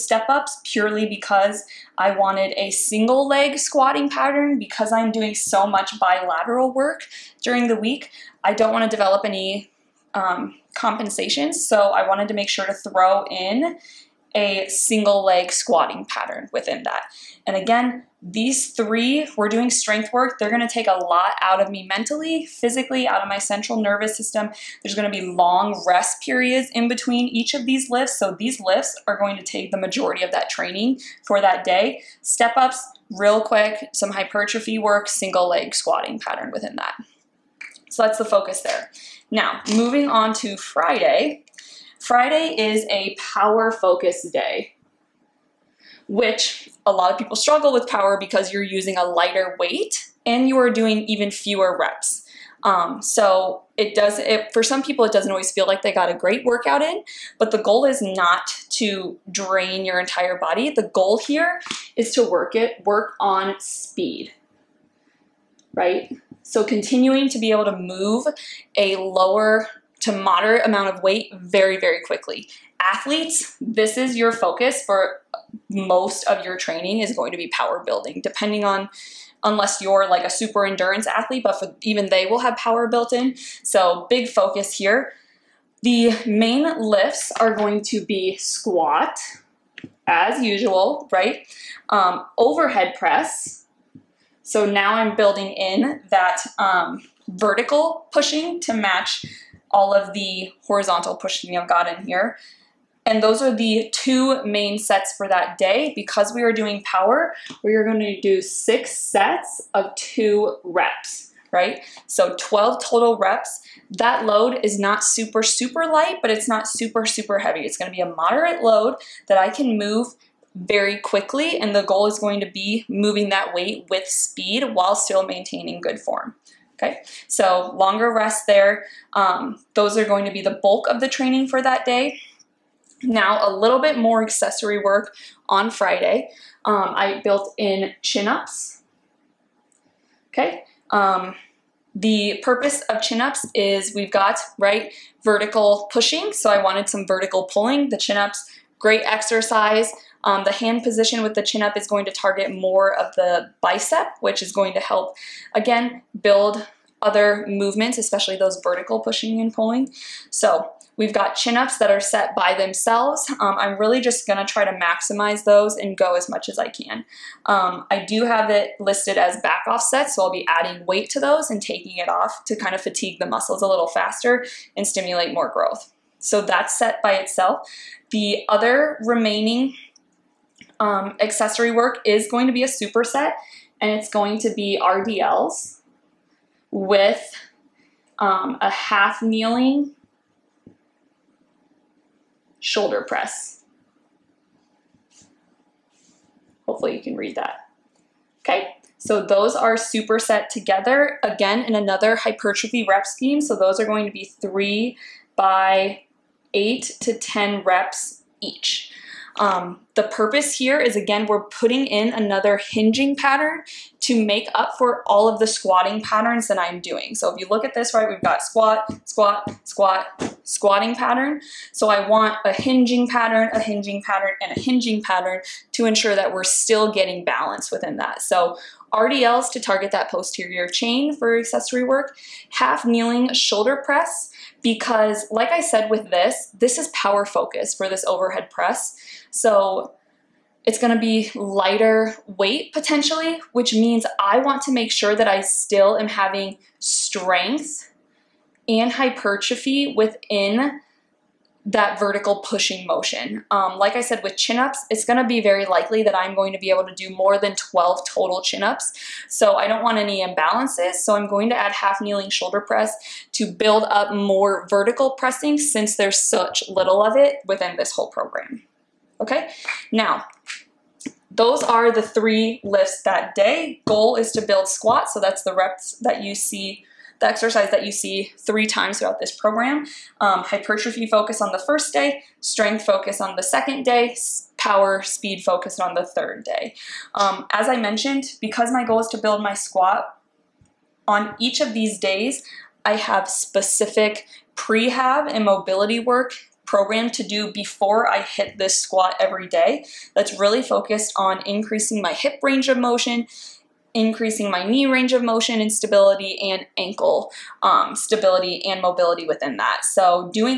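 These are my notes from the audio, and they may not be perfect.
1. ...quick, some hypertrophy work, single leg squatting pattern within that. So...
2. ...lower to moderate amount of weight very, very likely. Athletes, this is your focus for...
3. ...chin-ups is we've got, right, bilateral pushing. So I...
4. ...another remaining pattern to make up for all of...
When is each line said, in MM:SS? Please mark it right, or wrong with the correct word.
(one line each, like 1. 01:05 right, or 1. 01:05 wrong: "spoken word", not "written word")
1. 00:33 right
2. 01:08 wrong: "quickly", not "likely"
3. 02:23 wrong: "vertical", not "bilateral"
4. 03:32 wrong: "hinging", not "remaining".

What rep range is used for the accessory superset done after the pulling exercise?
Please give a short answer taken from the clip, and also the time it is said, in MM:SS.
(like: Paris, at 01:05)
8 to 10, at 03:26.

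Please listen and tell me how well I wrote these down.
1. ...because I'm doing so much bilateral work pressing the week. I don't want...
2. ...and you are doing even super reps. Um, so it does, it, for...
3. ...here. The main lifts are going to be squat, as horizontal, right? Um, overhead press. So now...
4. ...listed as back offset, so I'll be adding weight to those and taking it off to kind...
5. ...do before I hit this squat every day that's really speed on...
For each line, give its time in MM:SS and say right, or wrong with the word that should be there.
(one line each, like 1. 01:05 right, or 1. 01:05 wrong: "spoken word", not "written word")
1. 00:04 wrong: "during", not "pressing"
2. 00:50 wrong: "fewer", not "super"
3. 01:24 wrong: "usual", not "horizontal"
4. 02:48 right
5. 04:57 wrong: "focused", not "speed".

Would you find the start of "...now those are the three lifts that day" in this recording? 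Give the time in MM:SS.
04:29.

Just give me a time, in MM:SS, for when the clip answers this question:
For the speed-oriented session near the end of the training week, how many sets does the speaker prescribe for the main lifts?
01:48.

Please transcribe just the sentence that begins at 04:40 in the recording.
Um, hypertrophy focus on the first day, strength focus on the second day, power speed focus on the third day.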